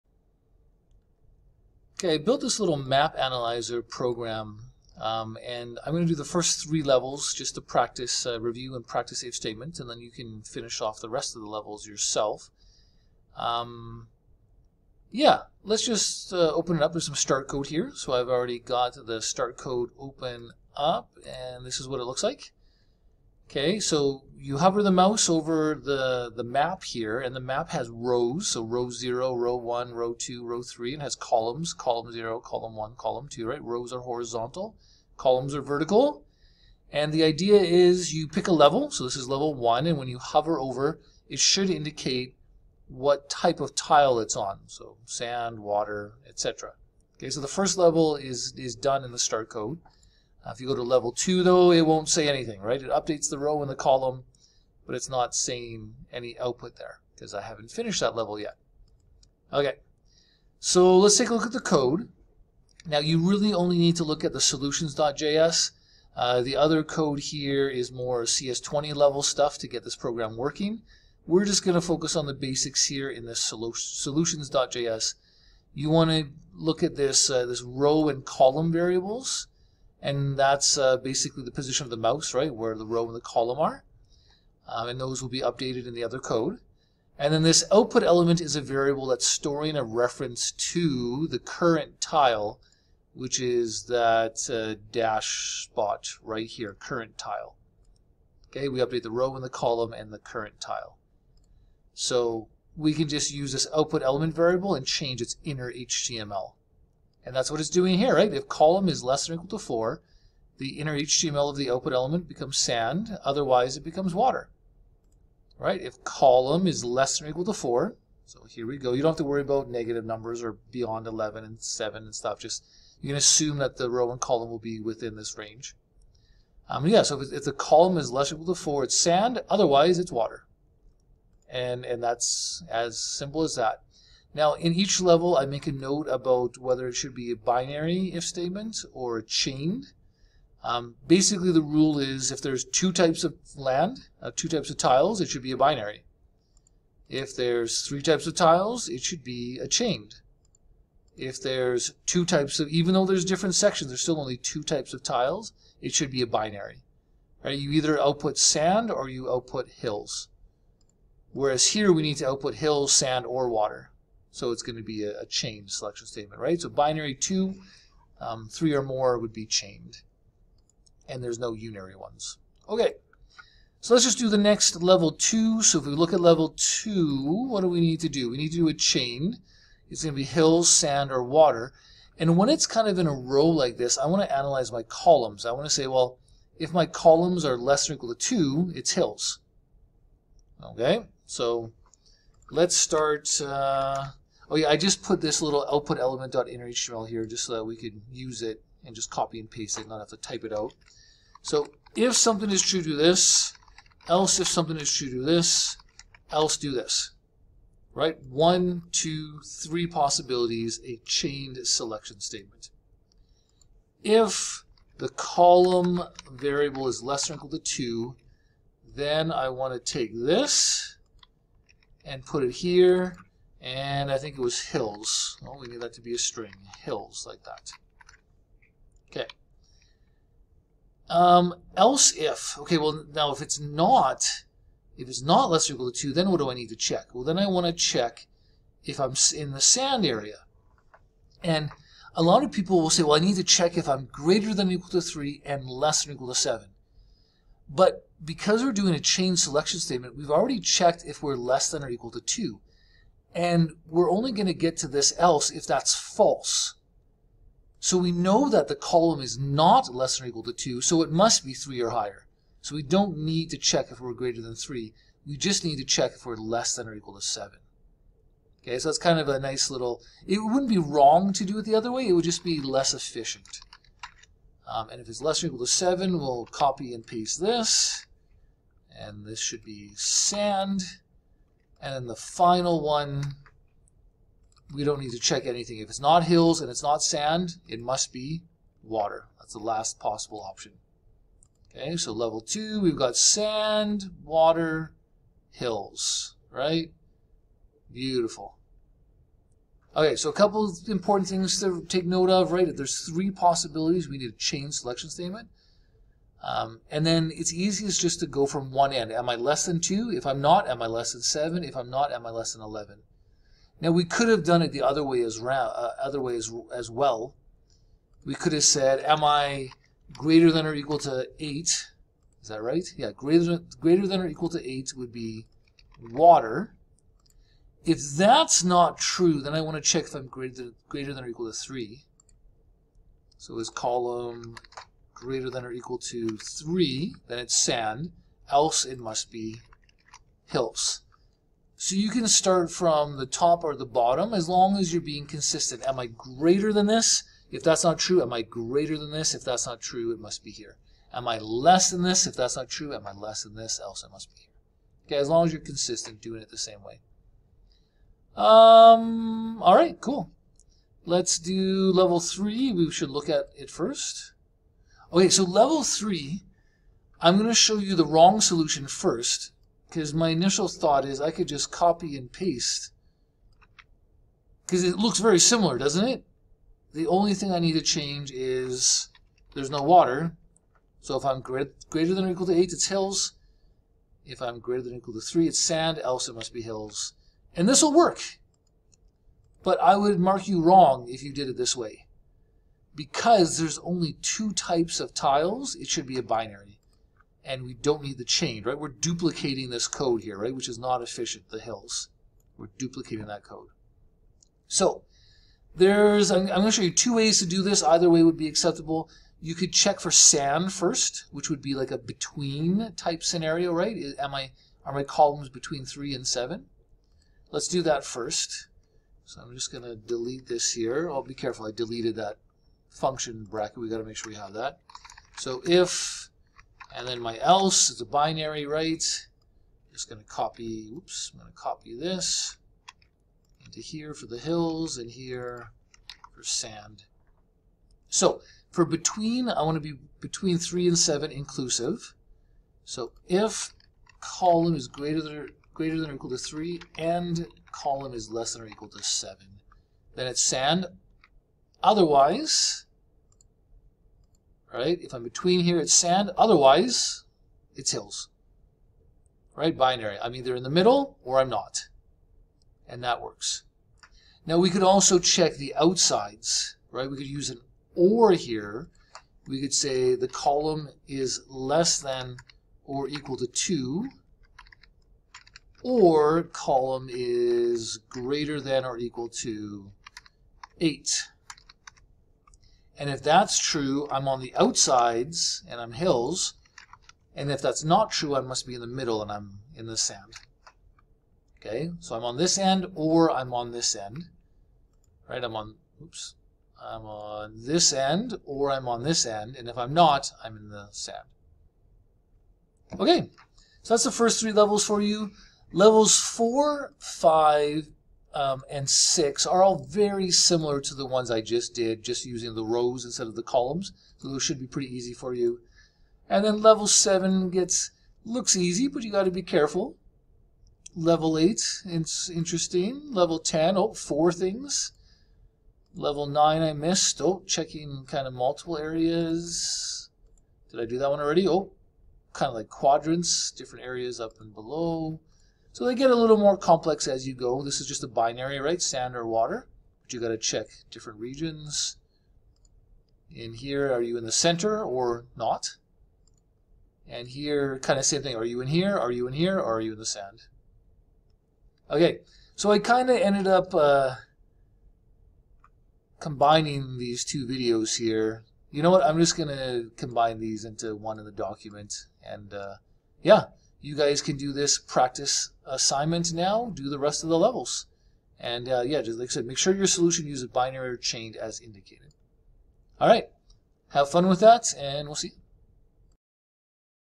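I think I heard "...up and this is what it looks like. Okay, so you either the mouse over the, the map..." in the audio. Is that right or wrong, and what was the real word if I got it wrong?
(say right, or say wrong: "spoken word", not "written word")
wrong: "hover", not "either".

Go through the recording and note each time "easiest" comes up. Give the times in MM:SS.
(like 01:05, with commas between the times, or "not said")
05:07.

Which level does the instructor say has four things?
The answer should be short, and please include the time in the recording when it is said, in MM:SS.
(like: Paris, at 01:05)
Level 10, at 08:43.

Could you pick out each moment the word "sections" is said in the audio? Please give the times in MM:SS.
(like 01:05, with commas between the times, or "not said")
02:33.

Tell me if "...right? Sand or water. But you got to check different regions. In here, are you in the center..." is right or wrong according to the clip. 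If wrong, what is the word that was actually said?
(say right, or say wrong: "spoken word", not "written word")
right.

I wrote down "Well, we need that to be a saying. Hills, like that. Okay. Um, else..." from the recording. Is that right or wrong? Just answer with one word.
wrong.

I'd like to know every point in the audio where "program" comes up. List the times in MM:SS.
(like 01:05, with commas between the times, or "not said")
00:03, 01:09.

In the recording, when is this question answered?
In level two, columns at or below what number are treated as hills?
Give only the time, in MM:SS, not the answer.
03:07.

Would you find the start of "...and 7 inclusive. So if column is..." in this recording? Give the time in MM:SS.
07:20.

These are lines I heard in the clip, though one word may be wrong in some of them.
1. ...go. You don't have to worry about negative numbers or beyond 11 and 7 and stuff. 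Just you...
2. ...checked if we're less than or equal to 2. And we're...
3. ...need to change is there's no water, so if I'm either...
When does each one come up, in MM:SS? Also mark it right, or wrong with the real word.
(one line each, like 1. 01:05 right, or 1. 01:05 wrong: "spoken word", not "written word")
1. 01:58 right
2. 04:10 right
3. 06:17 wrong: "greater", not "either".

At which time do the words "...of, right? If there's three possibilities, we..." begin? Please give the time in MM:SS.
05:02.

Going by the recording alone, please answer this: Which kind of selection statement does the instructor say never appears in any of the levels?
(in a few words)
unary.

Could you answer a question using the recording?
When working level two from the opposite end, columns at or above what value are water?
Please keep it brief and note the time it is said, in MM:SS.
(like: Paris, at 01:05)
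8, at 05:23.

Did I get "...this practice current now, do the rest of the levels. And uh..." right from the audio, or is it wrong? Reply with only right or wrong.
wrong.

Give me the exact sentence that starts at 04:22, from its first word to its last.
So we don't need to check if we're greater than 3.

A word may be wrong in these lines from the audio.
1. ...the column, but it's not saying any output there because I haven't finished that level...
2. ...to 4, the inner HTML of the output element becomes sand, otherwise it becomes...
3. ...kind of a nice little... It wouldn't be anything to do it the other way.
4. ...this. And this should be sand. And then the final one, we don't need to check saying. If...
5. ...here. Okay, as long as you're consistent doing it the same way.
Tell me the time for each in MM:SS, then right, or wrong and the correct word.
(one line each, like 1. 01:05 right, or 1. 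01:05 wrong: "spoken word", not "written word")
1. 00:53 right
2. 01:49 right
3. 04:28 wrong: "wrong", not "anything"
4. 04:37 wrong: "anything", not "saying"
5. 05:54 right.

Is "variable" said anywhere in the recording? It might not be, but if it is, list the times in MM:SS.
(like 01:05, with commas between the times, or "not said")
01:18, 01:28, 01:44, 03:36.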